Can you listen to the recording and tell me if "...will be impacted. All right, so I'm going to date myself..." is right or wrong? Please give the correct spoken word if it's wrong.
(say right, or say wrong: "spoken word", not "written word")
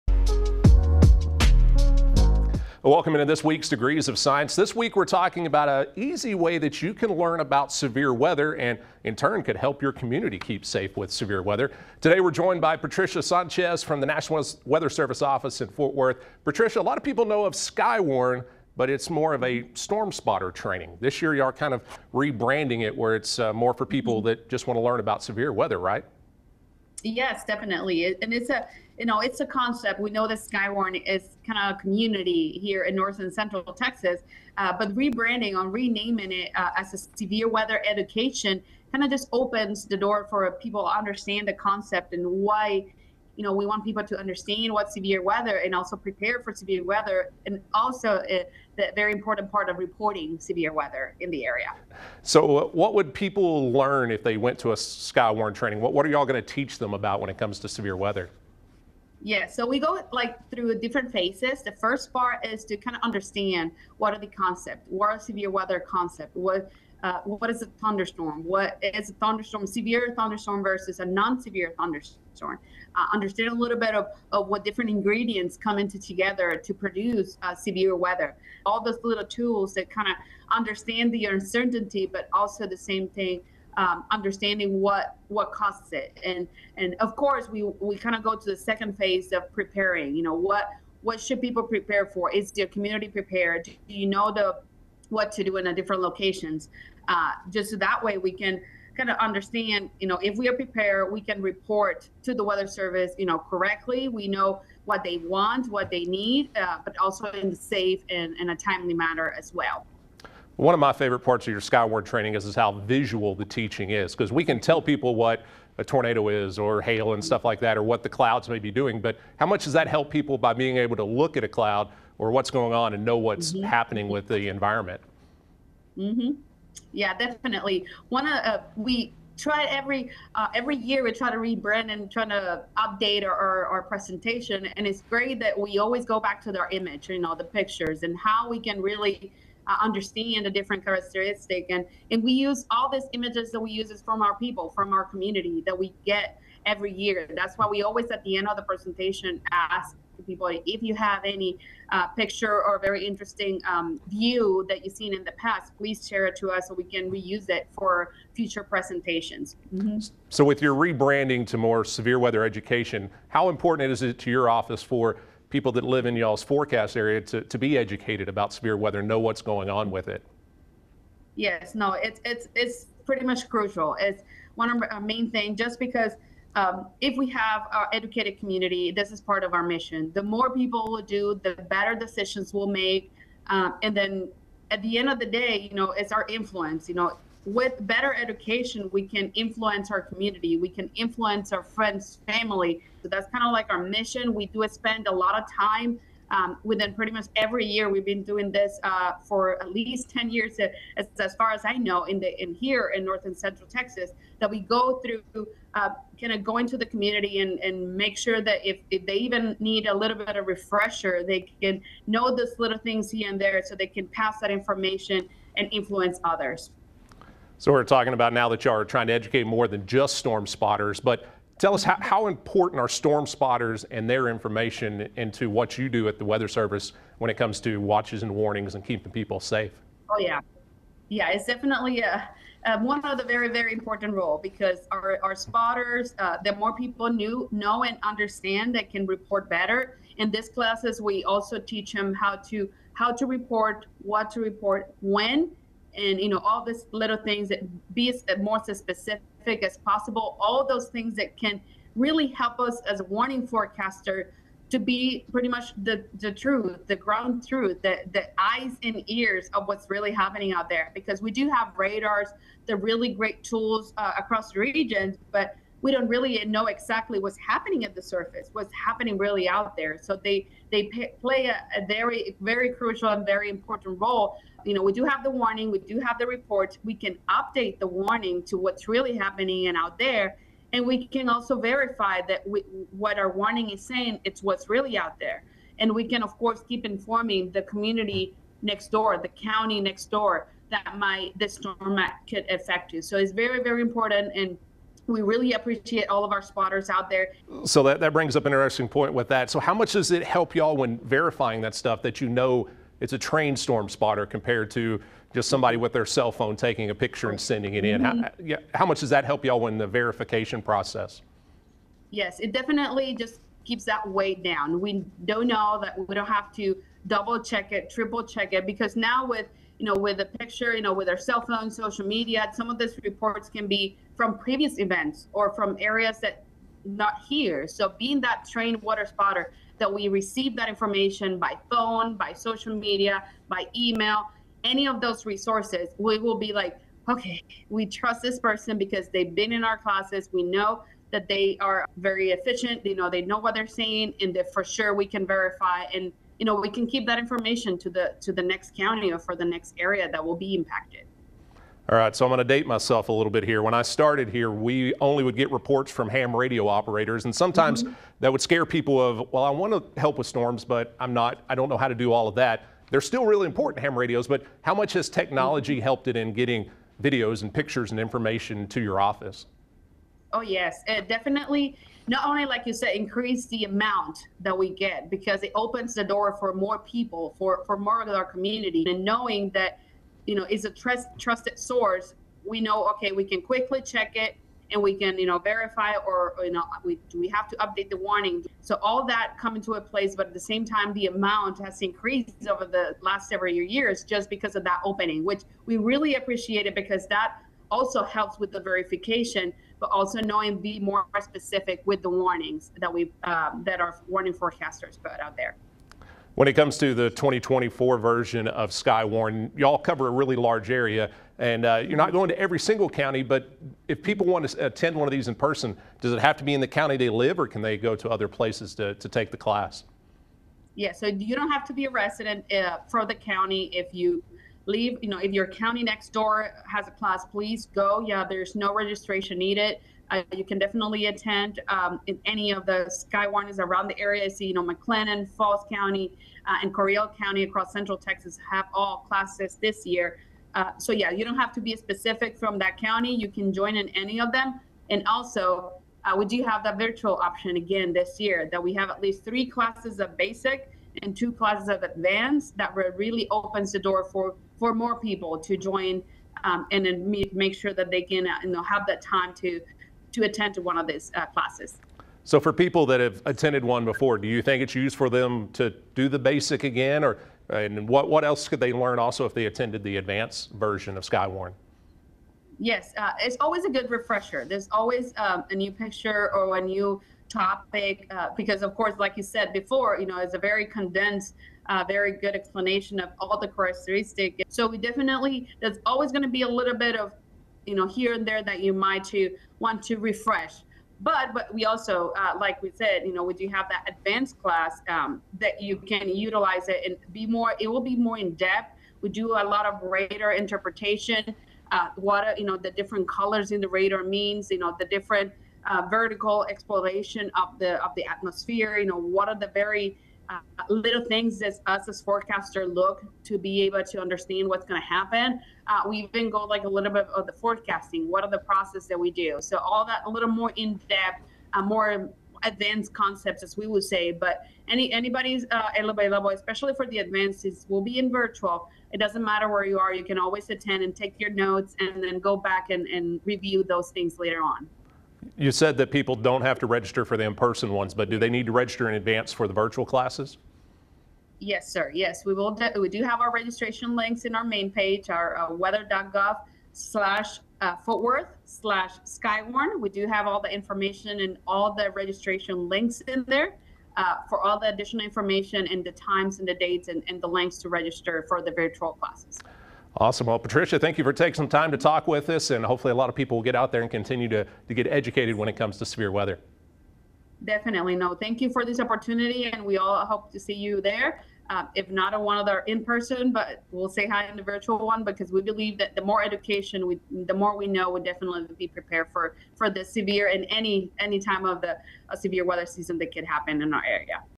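right.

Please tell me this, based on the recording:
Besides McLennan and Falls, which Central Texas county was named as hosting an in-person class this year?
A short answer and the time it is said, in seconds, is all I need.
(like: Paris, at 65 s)
Coryell County, at 436 s.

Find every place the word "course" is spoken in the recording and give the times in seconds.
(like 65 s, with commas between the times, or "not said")
87 s, 286 s, 478 s.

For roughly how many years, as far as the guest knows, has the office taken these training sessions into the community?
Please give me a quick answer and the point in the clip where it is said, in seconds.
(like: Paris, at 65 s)
At least 10 years, at 199 s.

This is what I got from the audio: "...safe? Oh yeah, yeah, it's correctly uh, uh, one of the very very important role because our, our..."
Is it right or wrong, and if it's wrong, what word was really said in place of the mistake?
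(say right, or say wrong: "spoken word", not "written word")
wrong: "definitely", not "correctly".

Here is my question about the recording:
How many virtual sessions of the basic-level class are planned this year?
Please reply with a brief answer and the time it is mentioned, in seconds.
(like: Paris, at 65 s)
3, at 449 s.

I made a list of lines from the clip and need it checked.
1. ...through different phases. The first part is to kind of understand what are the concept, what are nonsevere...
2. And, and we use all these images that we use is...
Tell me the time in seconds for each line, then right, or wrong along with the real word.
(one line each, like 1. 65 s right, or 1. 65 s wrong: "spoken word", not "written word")
1. 60 s wrong: "severe", not "nonsevere"
2. 141 s right.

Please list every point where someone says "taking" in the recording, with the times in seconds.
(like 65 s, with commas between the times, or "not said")
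306 s, 561 s.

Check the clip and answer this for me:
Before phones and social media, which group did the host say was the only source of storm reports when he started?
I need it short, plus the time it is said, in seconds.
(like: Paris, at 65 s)
Ham radio operators, at 356 s.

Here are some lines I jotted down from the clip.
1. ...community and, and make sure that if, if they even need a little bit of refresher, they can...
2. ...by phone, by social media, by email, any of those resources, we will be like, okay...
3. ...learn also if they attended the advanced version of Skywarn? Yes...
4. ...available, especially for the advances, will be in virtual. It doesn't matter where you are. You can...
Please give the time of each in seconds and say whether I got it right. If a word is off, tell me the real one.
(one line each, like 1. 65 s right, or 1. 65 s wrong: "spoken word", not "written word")
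1. 206 s right
2. 331 s right
3. 468 s right
4. 525 s right.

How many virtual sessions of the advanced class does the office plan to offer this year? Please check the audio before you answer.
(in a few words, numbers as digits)
2.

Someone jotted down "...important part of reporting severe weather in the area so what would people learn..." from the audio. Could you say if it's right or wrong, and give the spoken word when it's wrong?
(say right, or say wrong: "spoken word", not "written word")
right.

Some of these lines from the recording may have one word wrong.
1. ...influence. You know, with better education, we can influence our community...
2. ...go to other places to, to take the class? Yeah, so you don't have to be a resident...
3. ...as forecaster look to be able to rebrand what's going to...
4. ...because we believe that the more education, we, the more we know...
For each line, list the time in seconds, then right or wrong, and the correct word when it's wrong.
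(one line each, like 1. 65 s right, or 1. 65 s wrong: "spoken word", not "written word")
1. 186 s right
2. 417 s right
3. 511 s wrong: "understand", not "rebrand"
4. 575 s right.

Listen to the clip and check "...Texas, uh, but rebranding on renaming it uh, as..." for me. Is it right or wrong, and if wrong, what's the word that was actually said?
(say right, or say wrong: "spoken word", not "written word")
right.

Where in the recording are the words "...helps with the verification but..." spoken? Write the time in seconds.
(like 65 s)
398 s.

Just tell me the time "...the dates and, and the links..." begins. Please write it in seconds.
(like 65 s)
556 s.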